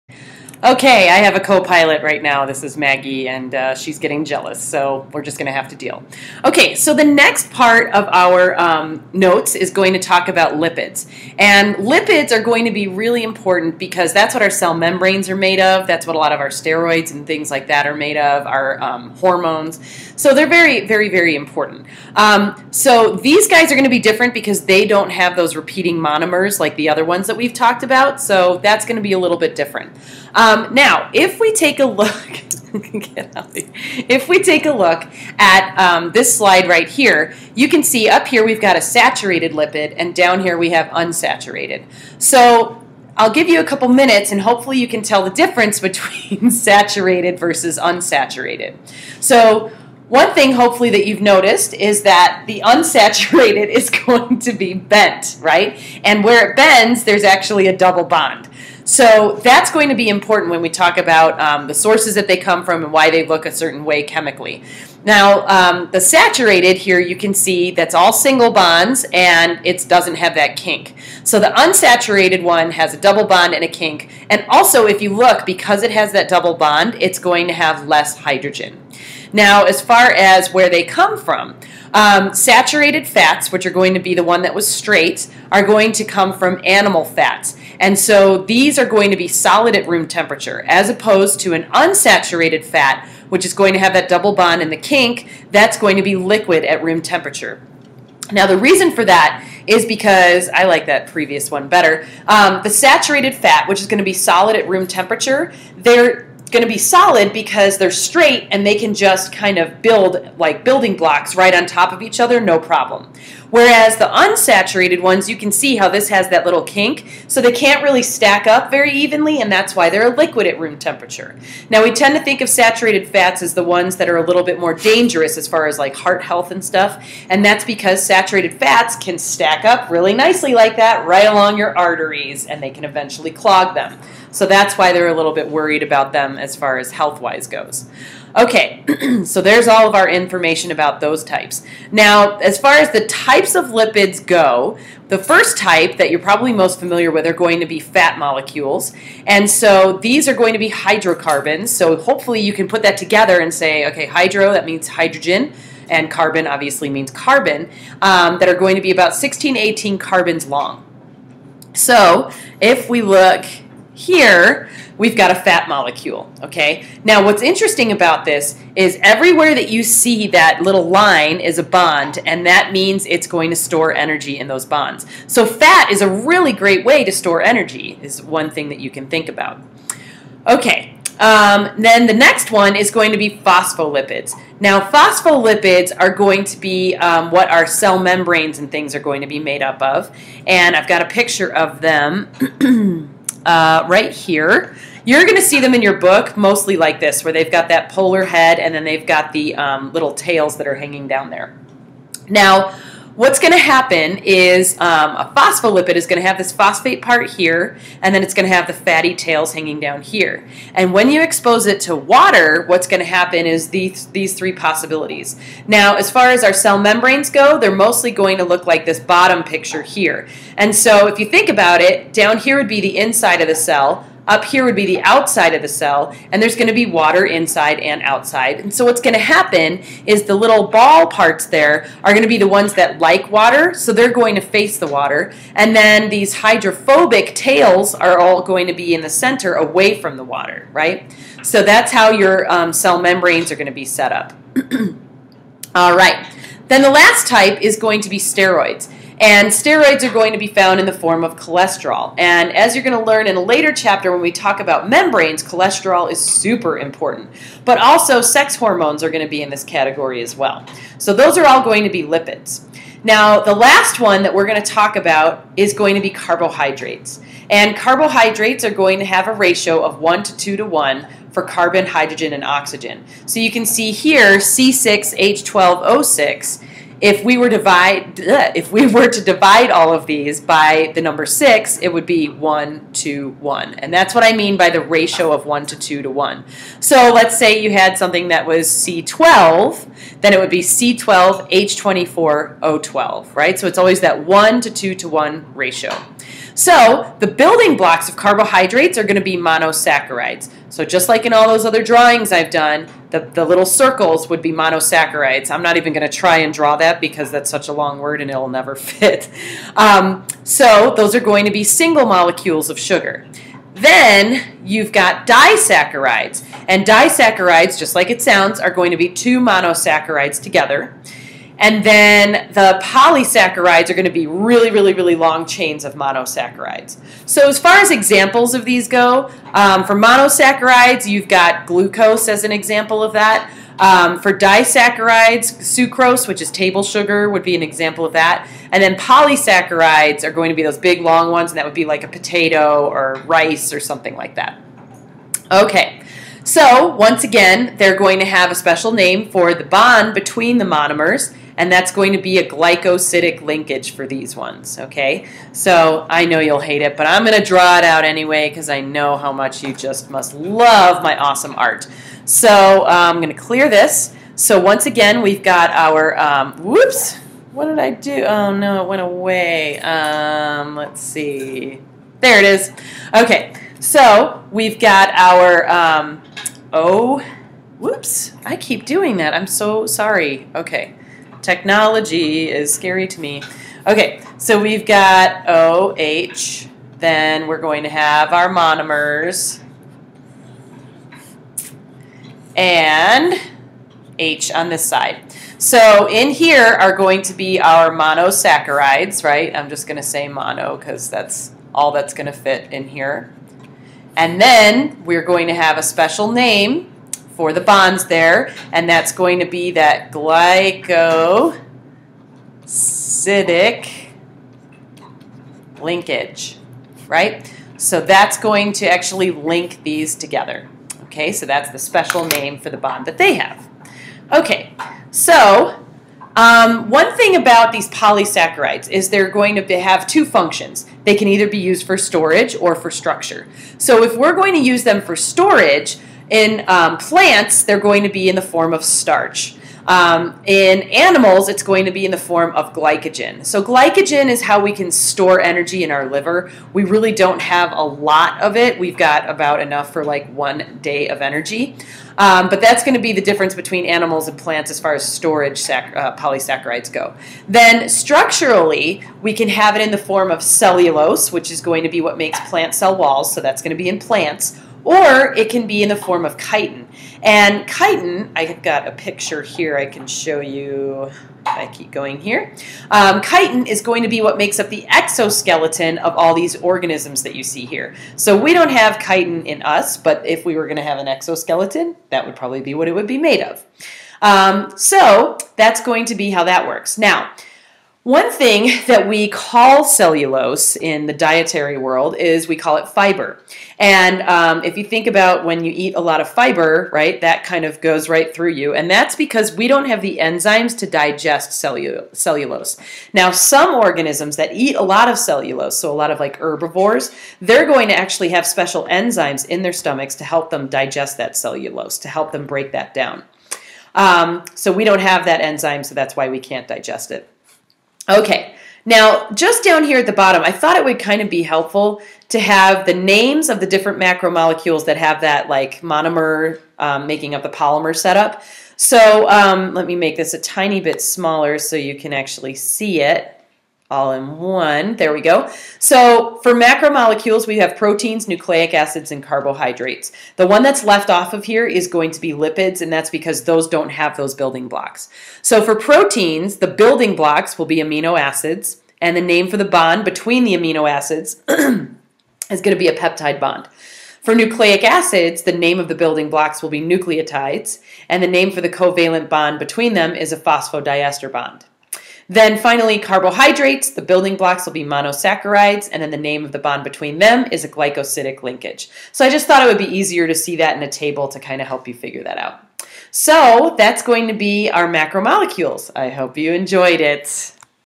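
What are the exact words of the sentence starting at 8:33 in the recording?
Um, so we don't have that enzyme, so that's why we can't digest it.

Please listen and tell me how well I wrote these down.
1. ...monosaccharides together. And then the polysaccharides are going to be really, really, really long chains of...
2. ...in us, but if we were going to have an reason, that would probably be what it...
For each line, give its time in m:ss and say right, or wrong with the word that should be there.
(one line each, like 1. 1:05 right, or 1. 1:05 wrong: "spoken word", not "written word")
1. 5:19 right
2. 7:59 wrong: "exoskeleton", not "reason".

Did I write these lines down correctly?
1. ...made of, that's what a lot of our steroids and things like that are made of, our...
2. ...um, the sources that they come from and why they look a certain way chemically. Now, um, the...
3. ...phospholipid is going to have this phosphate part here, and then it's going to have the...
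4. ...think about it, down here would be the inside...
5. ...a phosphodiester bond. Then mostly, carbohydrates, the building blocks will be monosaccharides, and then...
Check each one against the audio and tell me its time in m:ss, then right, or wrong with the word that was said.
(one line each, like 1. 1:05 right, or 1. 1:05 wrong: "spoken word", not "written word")
1. 0:15 right
2. 1:01 right
3. 3:25 right
4. 3:41 right
5. 9:20 wrong: "finally", not "mostly".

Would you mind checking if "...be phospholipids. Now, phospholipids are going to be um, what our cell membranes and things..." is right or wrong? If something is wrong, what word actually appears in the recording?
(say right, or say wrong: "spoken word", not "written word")
right.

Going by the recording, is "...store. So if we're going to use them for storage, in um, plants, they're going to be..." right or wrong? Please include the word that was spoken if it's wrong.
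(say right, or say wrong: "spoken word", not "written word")
wrong: "structure", not "store".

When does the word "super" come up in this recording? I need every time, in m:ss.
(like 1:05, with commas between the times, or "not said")
4:16.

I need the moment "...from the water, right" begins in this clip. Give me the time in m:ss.
3:59.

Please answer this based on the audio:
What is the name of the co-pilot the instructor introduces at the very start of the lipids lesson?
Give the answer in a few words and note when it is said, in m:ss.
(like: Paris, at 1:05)
Maggie, at 0:02.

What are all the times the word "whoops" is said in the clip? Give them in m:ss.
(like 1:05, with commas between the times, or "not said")
6:06, 6:17.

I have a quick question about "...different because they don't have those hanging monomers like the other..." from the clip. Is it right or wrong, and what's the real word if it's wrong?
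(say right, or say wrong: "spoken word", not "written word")
wrong: "repeating", not "hanging".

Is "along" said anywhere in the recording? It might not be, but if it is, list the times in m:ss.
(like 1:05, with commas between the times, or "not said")
2:11.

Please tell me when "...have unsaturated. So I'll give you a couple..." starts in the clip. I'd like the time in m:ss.
0:40.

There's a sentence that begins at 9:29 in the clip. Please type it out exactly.
So I just thought it would be easier to see that in a table to kind of help you figure that out.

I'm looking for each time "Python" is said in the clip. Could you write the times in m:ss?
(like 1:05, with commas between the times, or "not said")
not said.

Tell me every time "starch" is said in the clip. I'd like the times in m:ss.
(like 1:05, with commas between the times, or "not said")
7:18.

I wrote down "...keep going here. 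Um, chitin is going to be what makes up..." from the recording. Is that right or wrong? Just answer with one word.
right.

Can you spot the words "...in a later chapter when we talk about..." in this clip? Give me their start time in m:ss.
4:13.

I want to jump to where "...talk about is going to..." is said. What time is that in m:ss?
4:24.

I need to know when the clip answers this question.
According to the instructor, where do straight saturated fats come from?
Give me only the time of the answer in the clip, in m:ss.
1:26.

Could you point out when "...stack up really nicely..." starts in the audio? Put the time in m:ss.
2:09.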